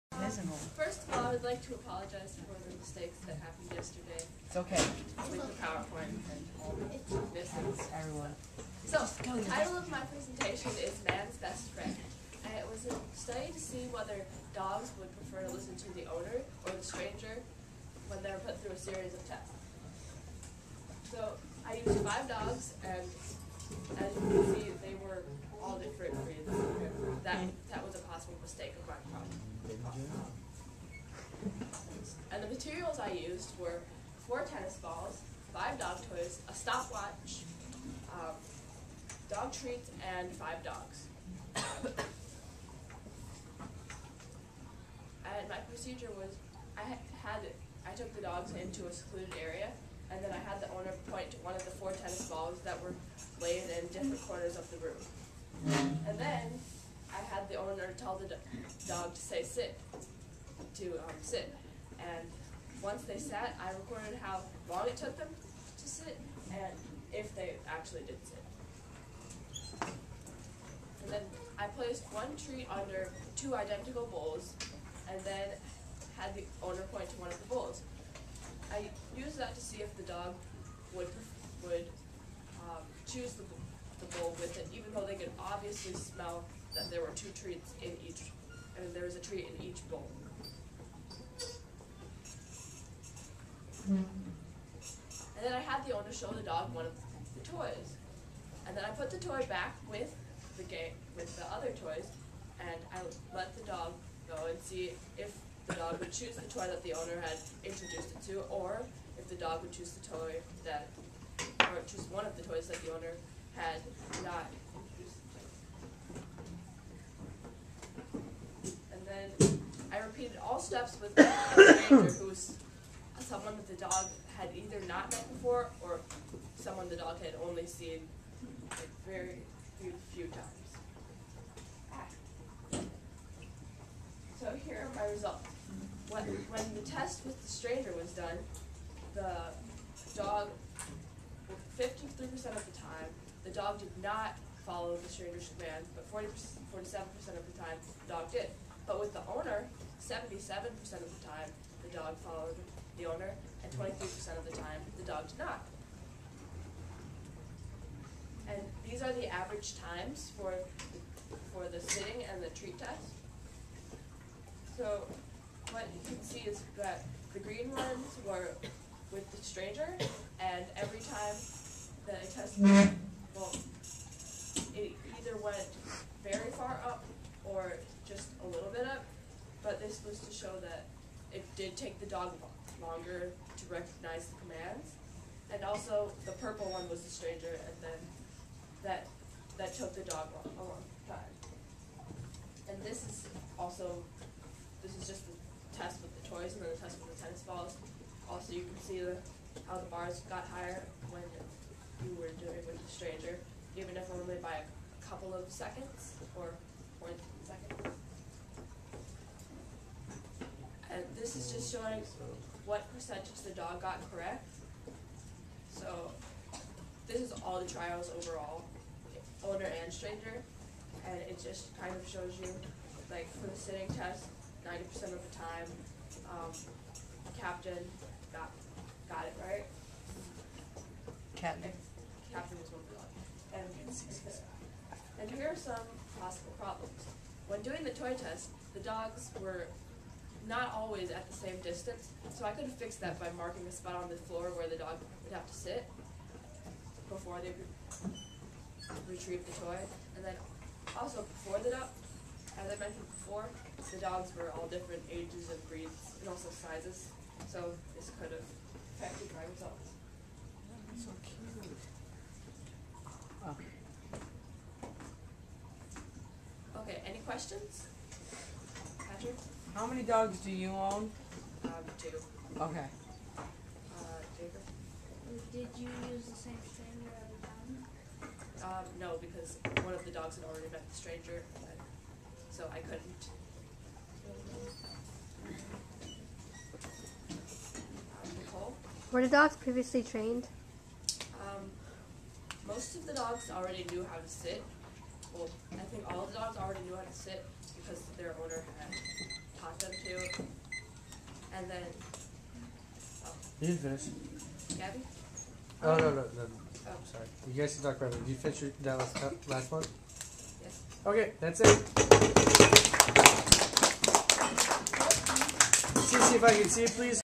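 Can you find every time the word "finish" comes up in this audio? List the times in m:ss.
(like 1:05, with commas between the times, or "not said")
5:03, 5:08.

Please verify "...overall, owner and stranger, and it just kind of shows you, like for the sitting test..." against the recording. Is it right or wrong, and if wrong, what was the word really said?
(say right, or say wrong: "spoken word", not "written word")
right.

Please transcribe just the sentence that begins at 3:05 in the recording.
And also, the purple one was the stranger, and then that that took the dog a long time.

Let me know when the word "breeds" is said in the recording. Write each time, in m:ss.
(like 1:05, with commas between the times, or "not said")
0:26, 4:15.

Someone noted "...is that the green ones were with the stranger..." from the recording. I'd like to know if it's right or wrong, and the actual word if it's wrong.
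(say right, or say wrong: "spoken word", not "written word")
right.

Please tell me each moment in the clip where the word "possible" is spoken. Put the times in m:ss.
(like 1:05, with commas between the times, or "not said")
0:28, 3:56.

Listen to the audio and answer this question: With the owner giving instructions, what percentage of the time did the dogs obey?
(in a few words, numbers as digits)
77%.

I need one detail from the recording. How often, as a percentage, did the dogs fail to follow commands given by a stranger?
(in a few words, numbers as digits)
53%.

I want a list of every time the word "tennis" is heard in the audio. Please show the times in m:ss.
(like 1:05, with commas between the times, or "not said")
0:34, 0:51, 3:17.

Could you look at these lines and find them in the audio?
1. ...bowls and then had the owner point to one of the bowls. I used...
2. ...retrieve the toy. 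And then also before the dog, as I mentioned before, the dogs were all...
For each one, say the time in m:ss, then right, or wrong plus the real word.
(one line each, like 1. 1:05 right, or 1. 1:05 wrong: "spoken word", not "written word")
1. 1:14 right
2. 4:09 right.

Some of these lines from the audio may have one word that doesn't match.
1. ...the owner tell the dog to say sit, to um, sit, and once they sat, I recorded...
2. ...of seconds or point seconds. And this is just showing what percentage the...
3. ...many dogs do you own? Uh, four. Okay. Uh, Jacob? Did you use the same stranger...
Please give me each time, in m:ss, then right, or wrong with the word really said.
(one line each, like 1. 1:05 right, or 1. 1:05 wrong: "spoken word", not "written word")
1. 0:57 right
2. 3:25 right
3. 4:29 wrong: "two", not "four".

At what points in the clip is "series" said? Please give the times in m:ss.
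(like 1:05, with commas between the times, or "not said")
0:18.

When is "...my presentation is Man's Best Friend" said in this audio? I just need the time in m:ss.
0:09.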